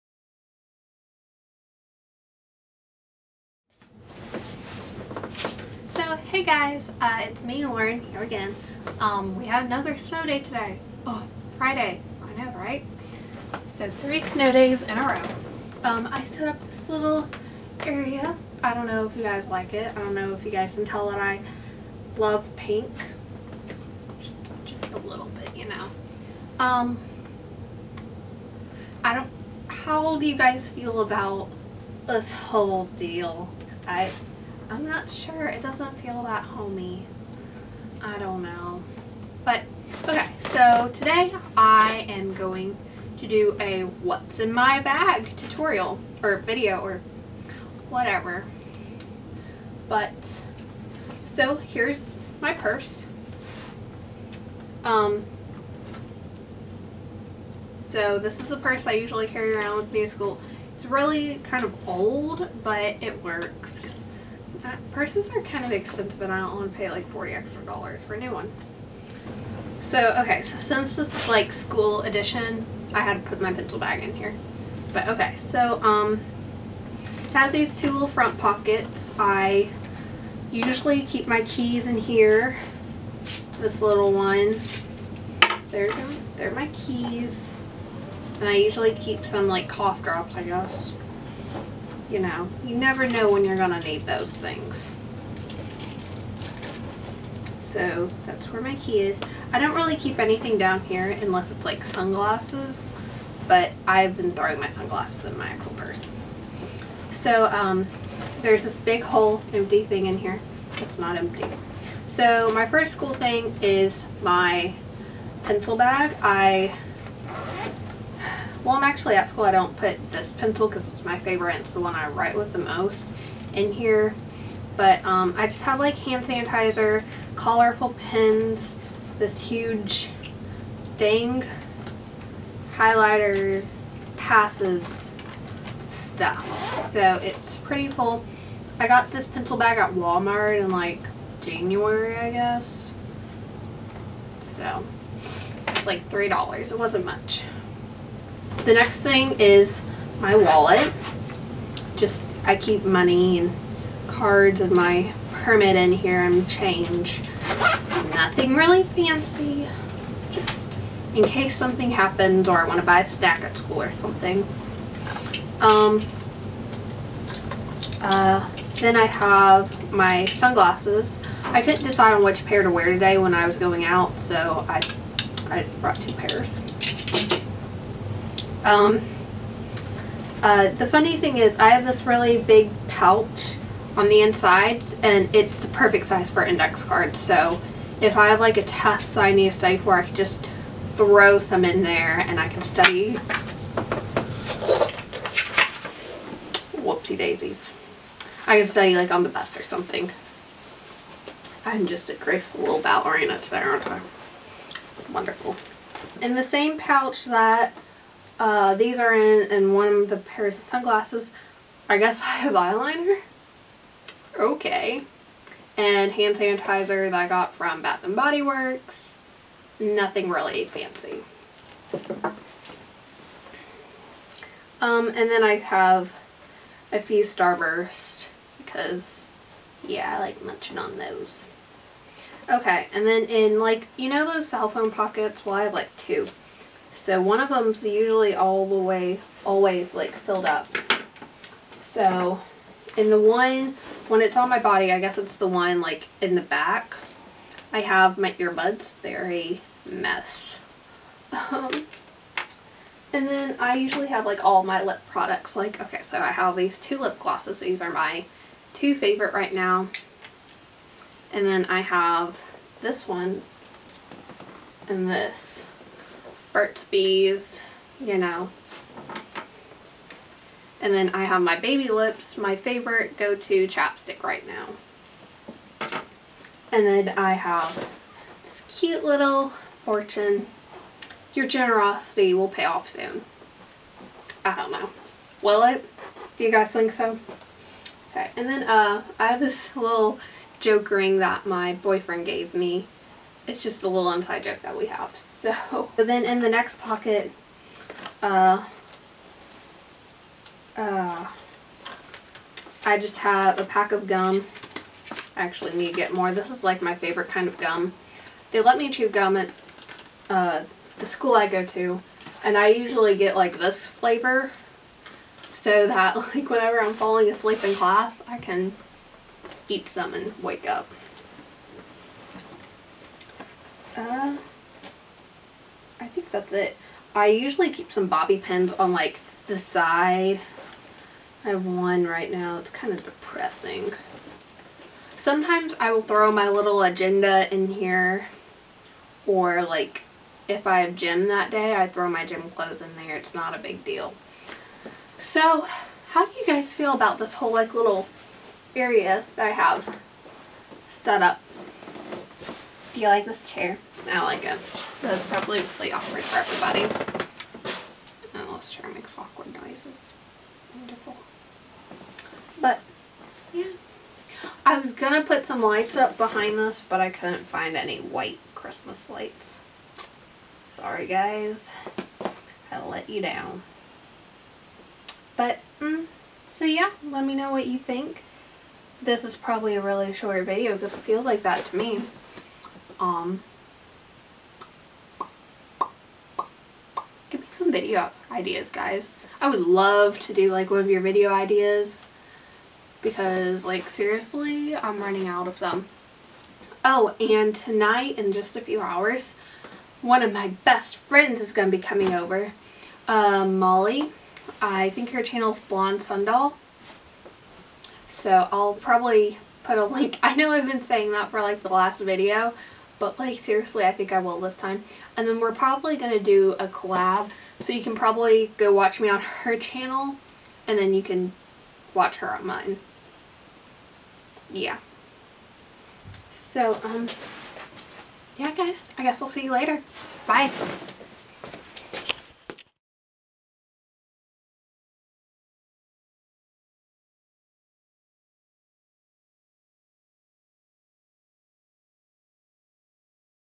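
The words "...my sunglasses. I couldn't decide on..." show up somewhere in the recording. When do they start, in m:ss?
2:49.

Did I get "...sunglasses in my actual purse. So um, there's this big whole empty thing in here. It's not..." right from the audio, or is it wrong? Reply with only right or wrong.
right.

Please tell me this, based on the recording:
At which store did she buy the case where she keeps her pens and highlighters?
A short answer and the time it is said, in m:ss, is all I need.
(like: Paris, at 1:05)
Walmart, at 2:19.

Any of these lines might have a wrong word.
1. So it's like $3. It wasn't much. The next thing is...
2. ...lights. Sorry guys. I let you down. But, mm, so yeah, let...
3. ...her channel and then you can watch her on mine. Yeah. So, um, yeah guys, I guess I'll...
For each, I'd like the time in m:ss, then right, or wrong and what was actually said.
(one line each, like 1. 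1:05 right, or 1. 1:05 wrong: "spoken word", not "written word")
1. 2:24 right
2. 6:09 right
3. 6:59 right.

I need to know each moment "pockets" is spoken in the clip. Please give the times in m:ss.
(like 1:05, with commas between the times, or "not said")
1:18, 3:54, 4:56.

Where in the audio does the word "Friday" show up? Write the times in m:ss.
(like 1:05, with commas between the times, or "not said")
0:11.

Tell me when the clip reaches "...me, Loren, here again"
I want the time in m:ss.
0:07.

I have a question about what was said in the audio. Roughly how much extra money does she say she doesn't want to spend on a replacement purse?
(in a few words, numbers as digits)
40 dollars.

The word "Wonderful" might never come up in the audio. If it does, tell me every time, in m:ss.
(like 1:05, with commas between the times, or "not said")
3:25, 6:00.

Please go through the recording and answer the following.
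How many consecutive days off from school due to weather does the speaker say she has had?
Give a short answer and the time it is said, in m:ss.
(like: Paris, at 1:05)
3, at 0:13.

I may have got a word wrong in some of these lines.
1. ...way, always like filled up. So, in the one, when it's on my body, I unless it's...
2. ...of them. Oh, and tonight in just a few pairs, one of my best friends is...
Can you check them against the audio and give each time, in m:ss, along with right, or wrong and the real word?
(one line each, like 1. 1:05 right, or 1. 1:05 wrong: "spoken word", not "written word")
1. 3:58 wrong: "guess", not "unless"
2. 6:35 wrong: "hours", not "pairs".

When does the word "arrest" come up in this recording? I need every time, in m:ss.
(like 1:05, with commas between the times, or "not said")
not said.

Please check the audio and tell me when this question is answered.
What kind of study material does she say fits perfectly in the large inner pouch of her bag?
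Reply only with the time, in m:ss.
3:06.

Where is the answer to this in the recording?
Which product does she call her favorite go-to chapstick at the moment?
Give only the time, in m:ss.
4:31.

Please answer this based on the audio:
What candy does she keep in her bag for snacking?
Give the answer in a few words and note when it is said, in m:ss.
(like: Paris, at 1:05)
Starburst, at 3:47.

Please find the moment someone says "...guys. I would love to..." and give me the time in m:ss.
6:28.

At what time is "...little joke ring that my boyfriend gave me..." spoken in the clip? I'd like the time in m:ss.
4:49.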